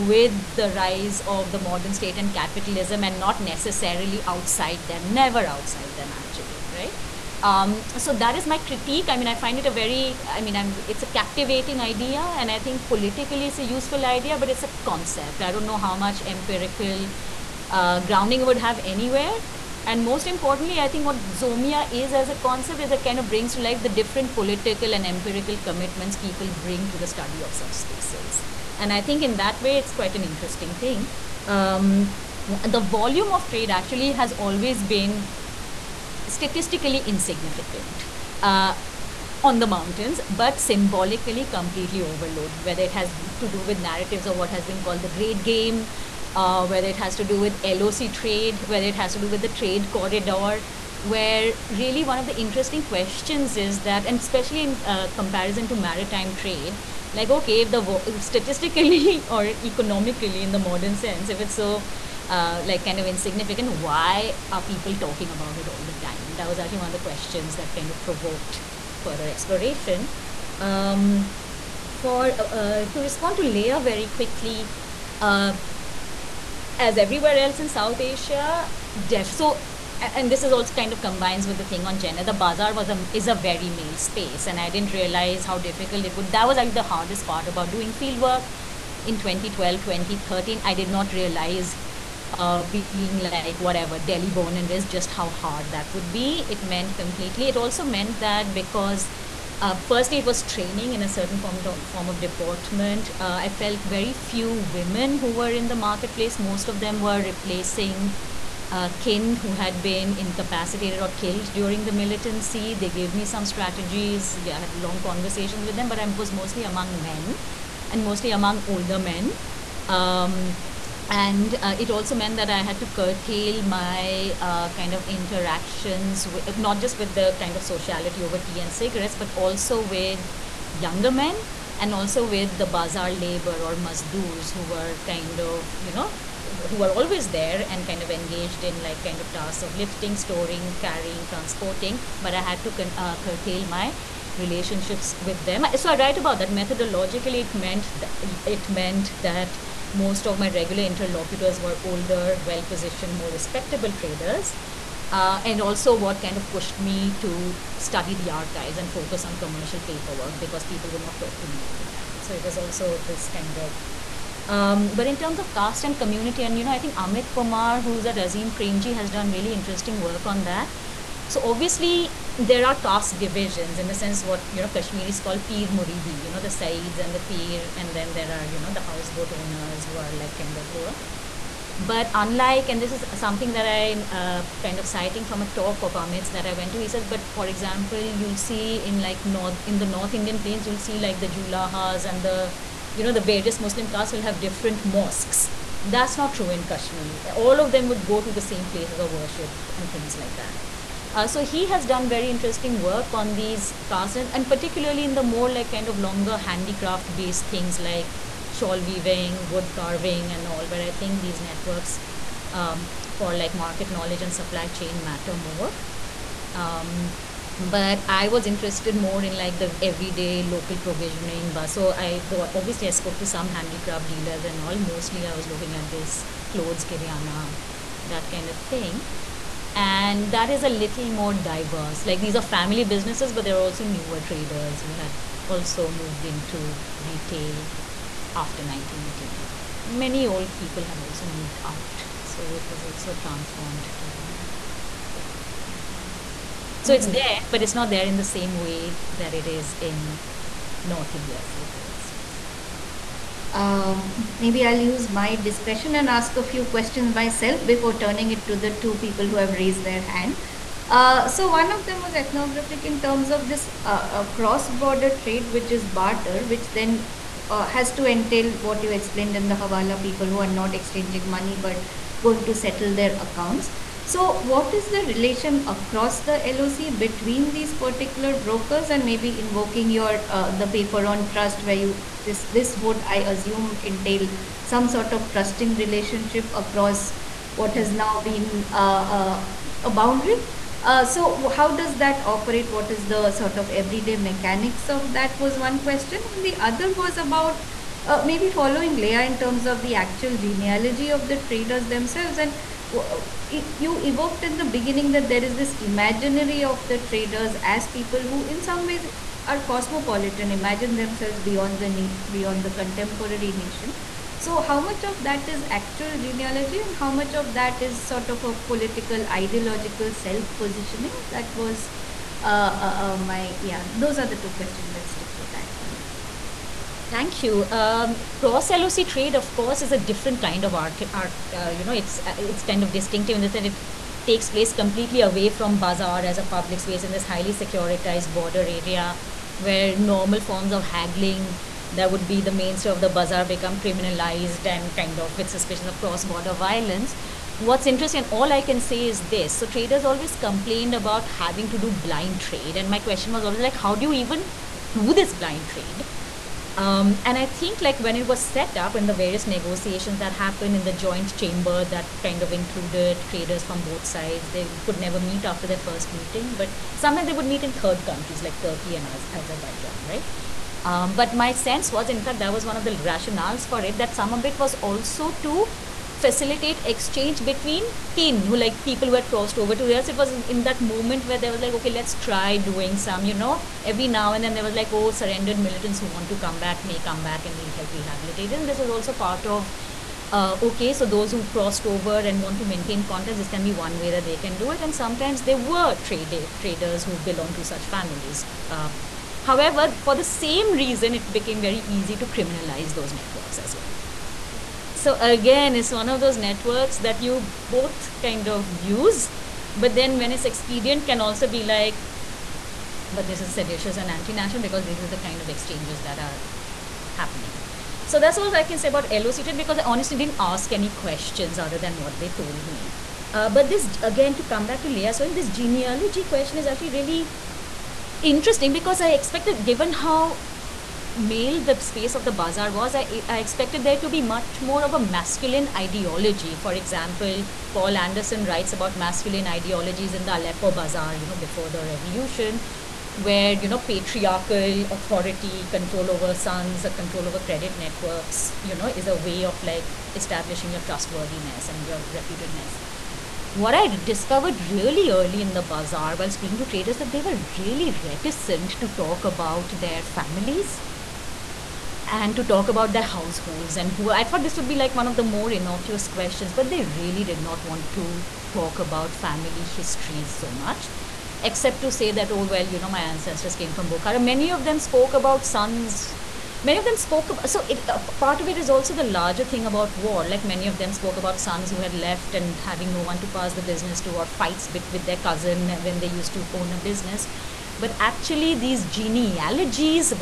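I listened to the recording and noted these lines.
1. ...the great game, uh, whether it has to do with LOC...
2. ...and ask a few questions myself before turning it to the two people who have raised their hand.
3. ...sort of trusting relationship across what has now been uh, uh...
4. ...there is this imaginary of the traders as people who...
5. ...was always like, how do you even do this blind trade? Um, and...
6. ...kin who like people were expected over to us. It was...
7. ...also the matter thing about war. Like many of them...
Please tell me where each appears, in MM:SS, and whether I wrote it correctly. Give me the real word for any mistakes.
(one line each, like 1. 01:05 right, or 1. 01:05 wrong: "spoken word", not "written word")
1. 00:45 right
2. 04:15 right
3. 04:44 right
4. 05:05 right
5. 05:53 right
6. 06:18 wrong: "crossed", not "expected"
7. 07:58 wrong: "larger", not "matter".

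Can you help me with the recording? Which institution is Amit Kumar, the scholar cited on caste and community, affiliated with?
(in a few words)
Azim Premji.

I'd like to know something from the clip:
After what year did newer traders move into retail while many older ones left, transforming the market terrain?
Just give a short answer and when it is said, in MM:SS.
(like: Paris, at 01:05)
1989, at 03:58.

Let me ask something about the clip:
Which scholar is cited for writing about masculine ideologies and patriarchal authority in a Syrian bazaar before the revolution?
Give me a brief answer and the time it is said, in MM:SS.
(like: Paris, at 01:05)
Paul Anderson, at 07:17.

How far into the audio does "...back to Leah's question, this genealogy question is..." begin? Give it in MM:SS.
07:04.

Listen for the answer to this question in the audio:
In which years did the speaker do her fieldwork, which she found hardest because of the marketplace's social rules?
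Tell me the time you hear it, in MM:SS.
01:29.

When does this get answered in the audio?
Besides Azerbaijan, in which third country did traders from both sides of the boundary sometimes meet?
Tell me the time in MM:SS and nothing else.
06:08.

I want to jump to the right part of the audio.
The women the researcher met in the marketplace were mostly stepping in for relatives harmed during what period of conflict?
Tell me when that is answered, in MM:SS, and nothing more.
01:51.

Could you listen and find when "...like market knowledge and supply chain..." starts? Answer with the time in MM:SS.
03:33.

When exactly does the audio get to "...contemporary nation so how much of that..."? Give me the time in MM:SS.
05:12.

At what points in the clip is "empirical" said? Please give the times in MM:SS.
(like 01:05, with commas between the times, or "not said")
00:16, 00:25.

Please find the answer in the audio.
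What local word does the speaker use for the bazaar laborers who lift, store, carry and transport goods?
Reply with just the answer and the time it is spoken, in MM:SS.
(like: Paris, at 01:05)
Mazdoors, at 02:13.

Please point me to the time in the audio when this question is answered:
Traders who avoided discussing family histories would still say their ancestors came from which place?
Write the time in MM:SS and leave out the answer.
07:53.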